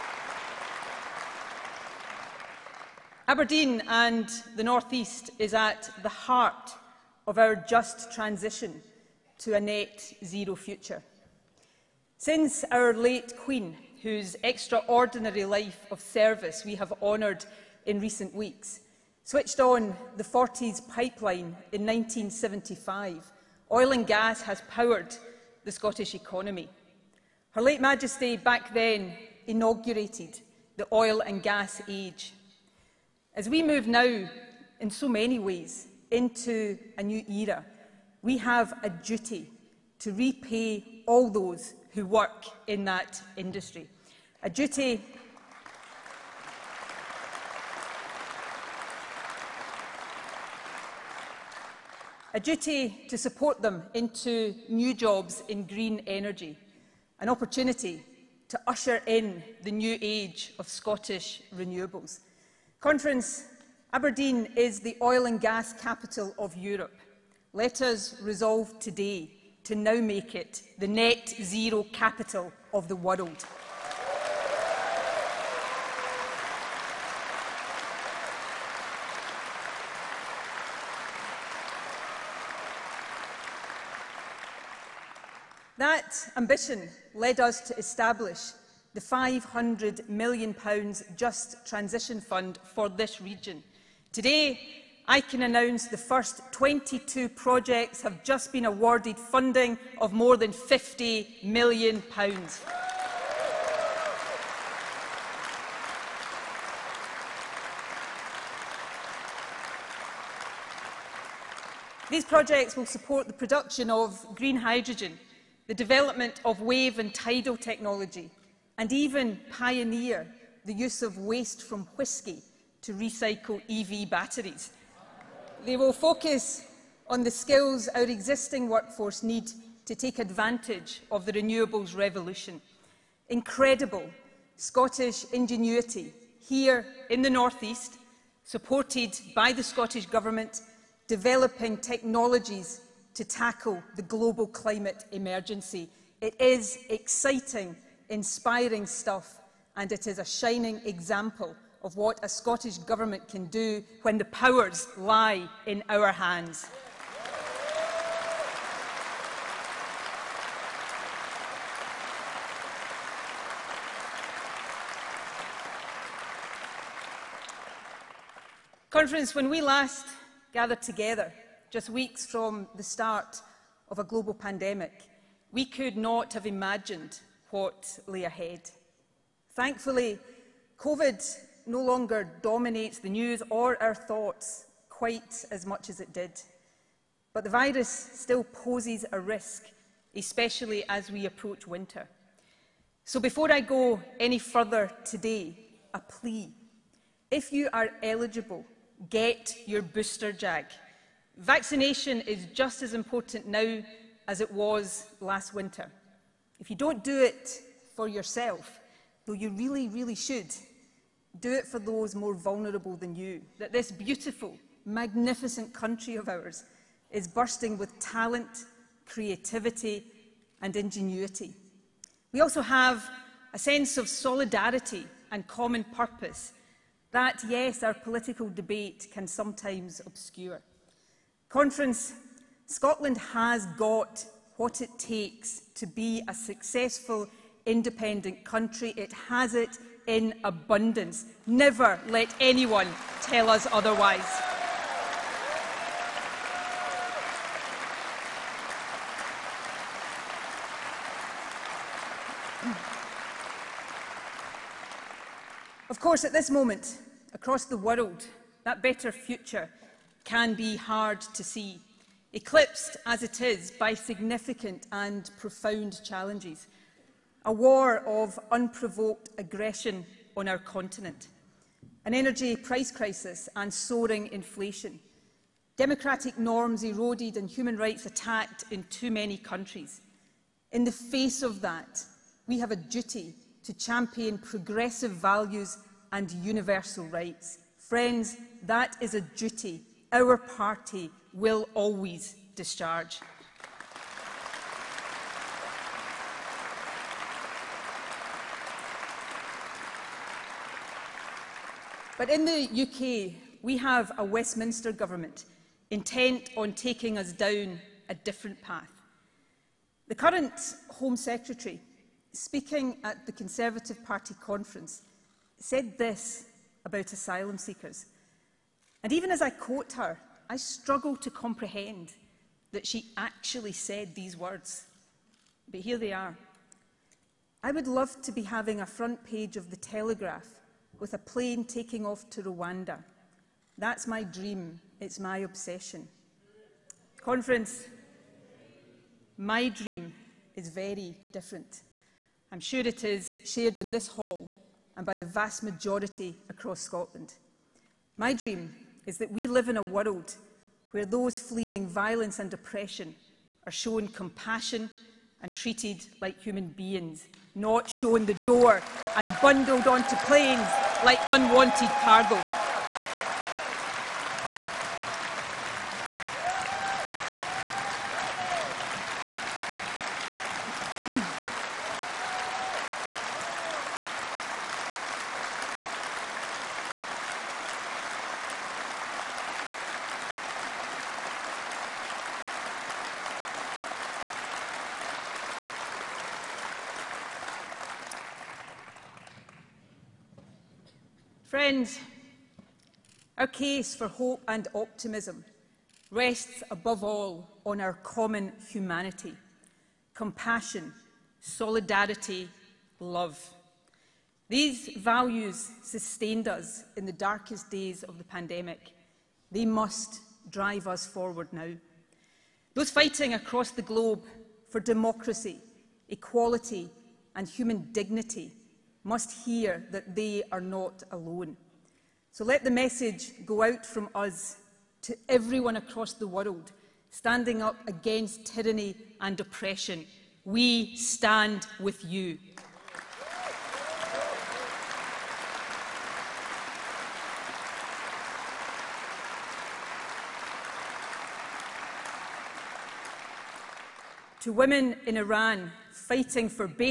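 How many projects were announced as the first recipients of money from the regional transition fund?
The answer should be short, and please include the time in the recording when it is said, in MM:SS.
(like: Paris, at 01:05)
22, at 01:36.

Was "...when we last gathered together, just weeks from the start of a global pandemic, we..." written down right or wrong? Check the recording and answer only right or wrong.
right.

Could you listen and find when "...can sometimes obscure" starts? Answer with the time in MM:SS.
03:49.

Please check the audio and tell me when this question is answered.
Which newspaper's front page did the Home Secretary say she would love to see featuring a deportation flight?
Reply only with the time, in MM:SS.
05:29.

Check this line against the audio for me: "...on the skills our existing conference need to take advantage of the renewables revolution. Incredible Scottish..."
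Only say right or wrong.
wrong.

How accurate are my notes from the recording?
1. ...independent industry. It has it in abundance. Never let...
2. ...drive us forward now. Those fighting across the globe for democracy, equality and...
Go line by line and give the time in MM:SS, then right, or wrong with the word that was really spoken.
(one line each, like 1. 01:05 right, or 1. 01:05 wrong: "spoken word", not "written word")
1. 03:57 wrong: "country", not "industry"
2. 06:50 right.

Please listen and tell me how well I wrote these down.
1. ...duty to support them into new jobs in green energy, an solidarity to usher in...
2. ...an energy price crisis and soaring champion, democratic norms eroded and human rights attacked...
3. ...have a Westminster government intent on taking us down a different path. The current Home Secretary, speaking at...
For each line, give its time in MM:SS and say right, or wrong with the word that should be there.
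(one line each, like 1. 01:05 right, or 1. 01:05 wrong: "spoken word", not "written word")
1. 00:52 wrong: "opportunity", not "solidarity"
2. 04:32 wrong: "inflation", not "champion"
3. 05:03 right.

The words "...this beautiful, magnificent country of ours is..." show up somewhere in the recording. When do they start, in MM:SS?
03:33.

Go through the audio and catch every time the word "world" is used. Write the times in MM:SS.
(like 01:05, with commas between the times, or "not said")
01:12, 04:17, 05:49, 07:06.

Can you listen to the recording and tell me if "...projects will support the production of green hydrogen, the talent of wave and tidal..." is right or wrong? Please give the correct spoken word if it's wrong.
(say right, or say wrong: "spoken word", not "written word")
wrong: "development", not "talent".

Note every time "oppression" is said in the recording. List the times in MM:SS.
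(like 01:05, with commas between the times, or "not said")
05:52, 07:09.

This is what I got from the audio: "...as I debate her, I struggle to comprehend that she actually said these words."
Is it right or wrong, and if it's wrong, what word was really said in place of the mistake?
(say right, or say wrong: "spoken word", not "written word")
wrong: "quote", not "debate".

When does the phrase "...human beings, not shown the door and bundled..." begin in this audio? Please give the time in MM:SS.
05:56.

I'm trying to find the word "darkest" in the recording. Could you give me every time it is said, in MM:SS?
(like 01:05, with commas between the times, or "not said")
06:47.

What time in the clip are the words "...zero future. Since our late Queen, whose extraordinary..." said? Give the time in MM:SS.
00:10.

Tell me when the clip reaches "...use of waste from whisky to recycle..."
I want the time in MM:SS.
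02:00.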